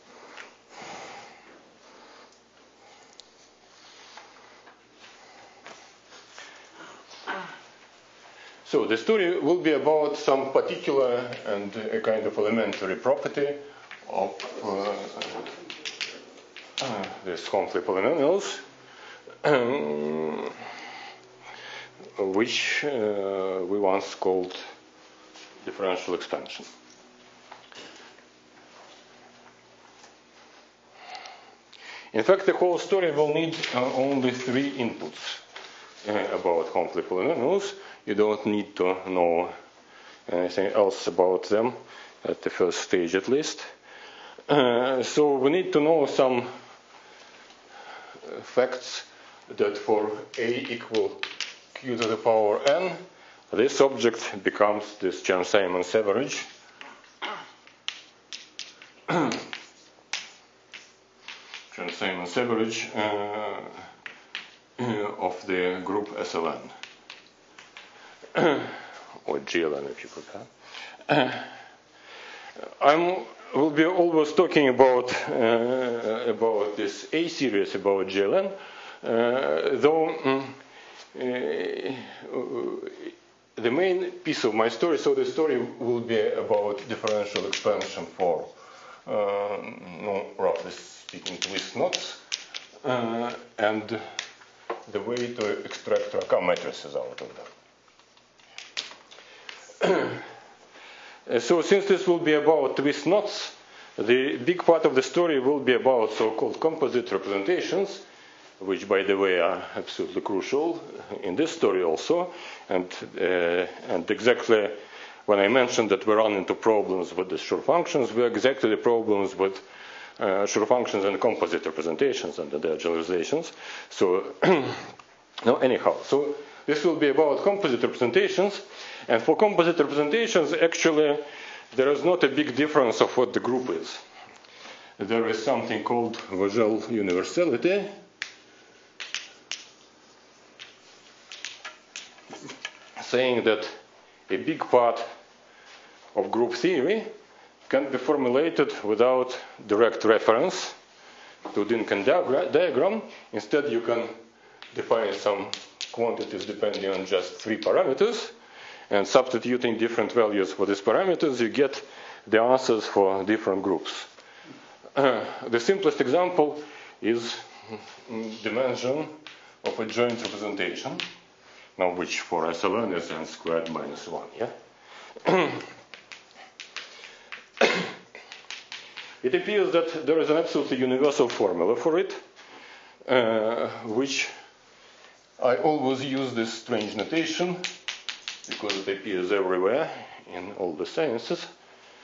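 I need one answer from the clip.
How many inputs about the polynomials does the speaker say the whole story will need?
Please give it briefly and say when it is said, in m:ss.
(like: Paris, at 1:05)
3, at 0:34.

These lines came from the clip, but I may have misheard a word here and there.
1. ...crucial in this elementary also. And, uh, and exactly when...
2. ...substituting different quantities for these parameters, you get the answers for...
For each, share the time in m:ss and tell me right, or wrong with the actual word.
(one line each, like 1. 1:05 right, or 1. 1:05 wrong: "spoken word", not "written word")
1. 1:50 wrong: "story", not "elementary"
2. 2:39 wrong: "values", not "quantities".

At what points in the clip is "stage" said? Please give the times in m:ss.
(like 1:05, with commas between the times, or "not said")
0:42.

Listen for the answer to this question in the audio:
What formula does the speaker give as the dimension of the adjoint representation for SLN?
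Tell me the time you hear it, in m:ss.
2:53.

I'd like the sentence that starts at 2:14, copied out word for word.
There is something called visual universality.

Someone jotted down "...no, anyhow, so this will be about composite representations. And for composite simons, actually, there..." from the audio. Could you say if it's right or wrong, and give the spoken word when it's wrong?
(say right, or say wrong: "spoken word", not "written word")
wrong: "representations", not "simons".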